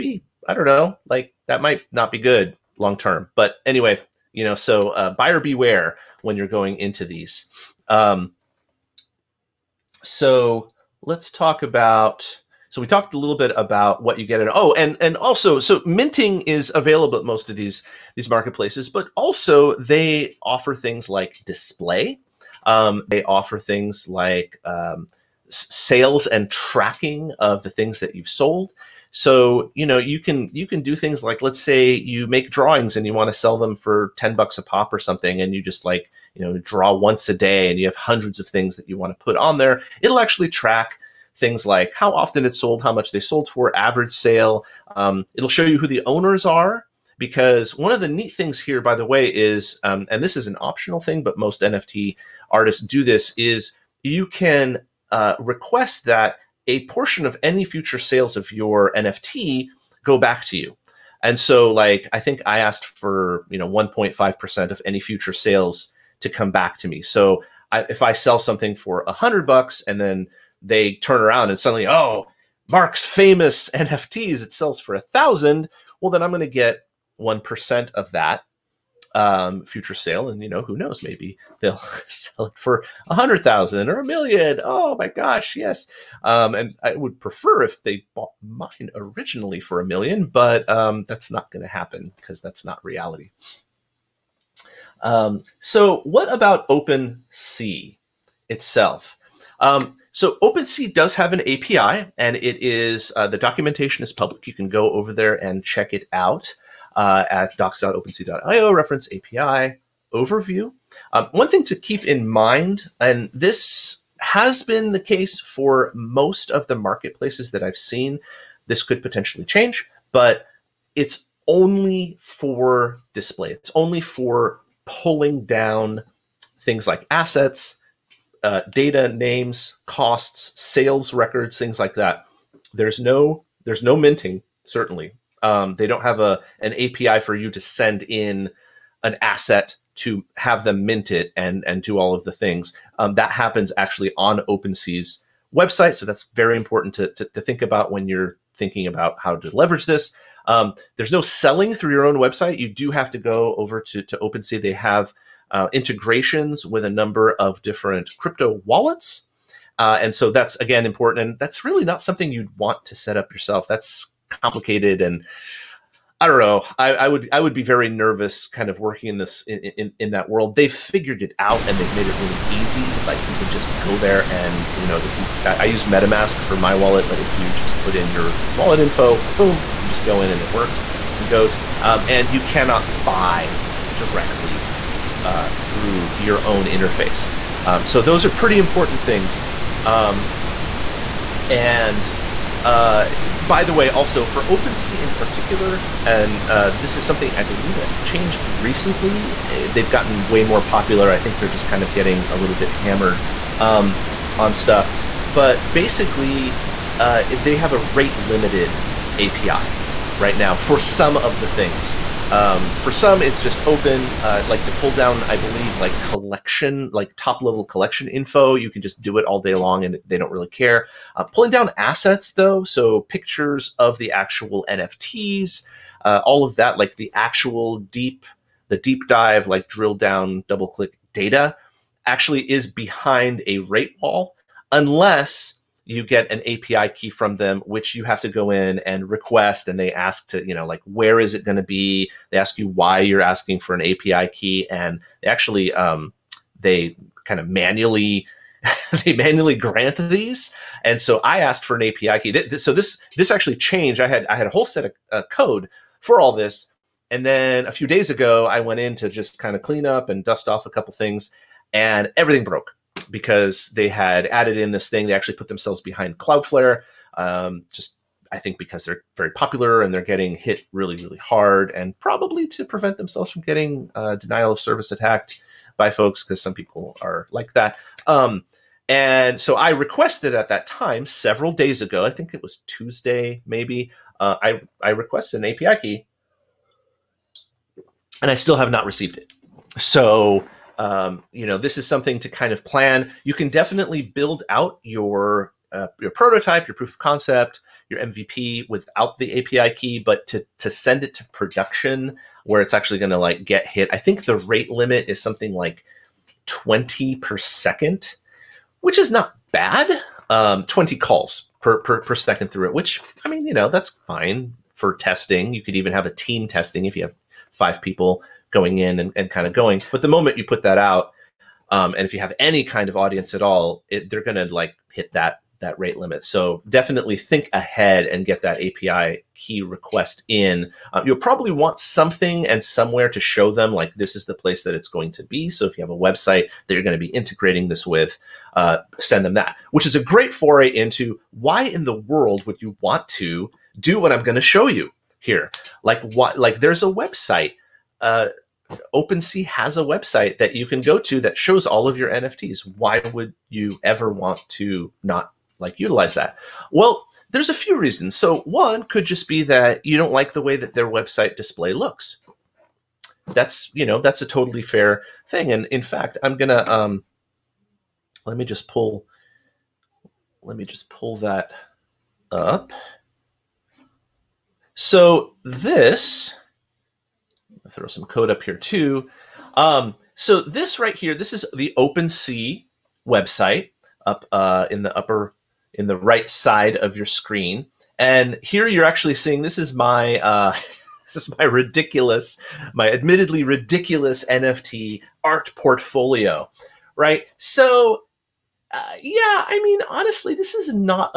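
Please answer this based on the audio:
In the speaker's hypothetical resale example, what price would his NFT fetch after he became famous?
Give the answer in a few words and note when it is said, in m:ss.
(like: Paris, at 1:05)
1000, at 1:14.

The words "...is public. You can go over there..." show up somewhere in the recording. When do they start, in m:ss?
1:44.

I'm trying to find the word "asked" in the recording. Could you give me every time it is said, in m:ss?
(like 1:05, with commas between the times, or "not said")
1:02, 4:11.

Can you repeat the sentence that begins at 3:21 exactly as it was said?
I think they're just kind of getting a little bit hammered um, on stuff.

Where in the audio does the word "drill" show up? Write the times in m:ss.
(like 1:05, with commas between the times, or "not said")
3:49.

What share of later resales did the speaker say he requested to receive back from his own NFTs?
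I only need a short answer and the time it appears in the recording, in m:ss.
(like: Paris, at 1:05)
1.5%, at 1:03.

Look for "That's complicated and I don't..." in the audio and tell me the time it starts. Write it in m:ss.
2:43.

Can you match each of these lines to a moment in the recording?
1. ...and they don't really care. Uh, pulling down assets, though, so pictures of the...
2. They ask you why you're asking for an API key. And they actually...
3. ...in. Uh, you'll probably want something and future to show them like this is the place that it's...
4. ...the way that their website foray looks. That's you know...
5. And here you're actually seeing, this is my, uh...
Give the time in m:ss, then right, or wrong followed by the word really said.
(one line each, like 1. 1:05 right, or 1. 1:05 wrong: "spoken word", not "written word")
1. 3:39 right
2. 4:02 right
3. 5:30 wrong: "somewhere", not "future"
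4. 6:00 wrong: "display", not "foray"
5. 6:27 right.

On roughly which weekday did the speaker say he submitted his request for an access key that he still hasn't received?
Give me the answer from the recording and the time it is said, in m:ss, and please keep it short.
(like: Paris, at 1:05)
Tuesday, at 4:42.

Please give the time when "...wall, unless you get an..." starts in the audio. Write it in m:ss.
3:54.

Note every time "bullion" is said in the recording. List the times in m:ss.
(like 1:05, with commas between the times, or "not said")
not said.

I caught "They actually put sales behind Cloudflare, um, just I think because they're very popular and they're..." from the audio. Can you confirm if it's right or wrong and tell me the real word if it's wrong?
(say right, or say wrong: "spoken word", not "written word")
wrong: "themselves", not "sales".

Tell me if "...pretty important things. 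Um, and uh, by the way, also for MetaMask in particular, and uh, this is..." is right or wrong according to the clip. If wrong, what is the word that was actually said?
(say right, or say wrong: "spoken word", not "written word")
wrong: "OpenSea", not "MetaMask".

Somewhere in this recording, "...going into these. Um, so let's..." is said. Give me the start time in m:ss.
0:06.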